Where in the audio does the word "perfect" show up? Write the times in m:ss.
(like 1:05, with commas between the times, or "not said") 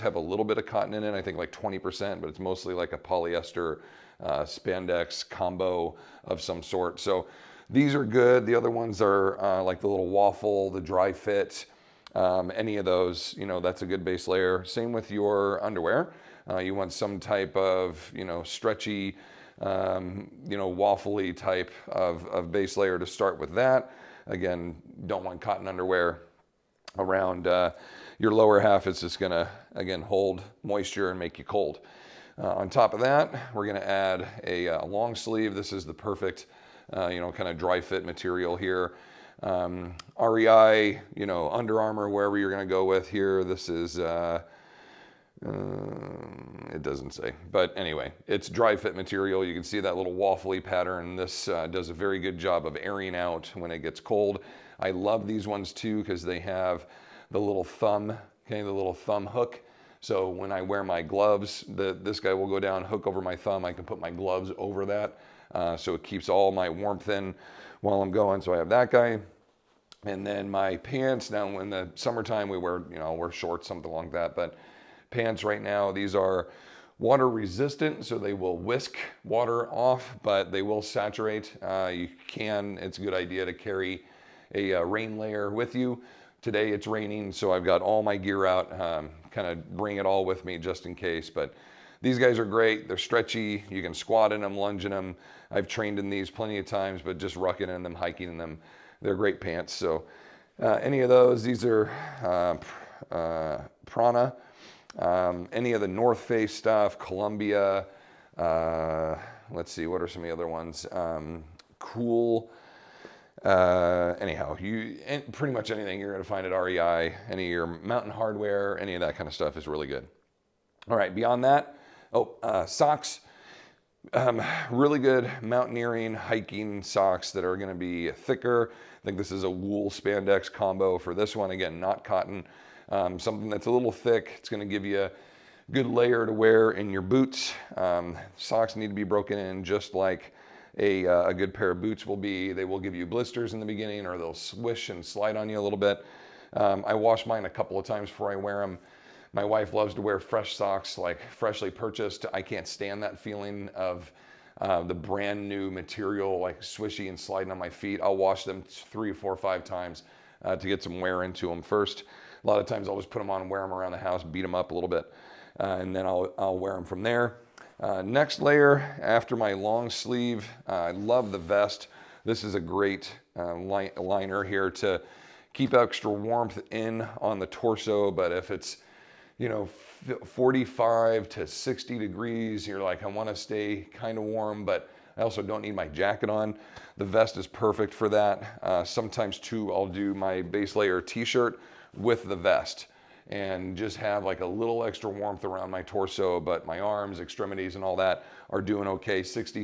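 0:35, 3:07.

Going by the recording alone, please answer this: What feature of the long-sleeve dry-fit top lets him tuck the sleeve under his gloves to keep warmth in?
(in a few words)
thumb hook.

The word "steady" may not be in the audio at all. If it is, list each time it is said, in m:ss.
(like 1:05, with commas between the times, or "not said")
not said.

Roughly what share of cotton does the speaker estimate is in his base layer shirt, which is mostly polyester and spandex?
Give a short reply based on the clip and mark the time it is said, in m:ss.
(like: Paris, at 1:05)
20%, at 0:01.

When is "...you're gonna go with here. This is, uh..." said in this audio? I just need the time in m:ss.
0:42.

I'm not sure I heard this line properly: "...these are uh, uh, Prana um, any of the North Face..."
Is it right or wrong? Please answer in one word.
right.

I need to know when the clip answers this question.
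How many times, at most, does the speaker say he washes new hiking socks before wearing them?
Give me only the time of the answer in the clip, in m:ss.
2:39.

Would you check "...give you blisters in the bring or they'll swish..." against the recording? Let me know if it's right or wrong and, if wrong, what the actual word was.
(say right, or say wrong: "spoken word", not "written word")
wrong: "beginning", not "bring".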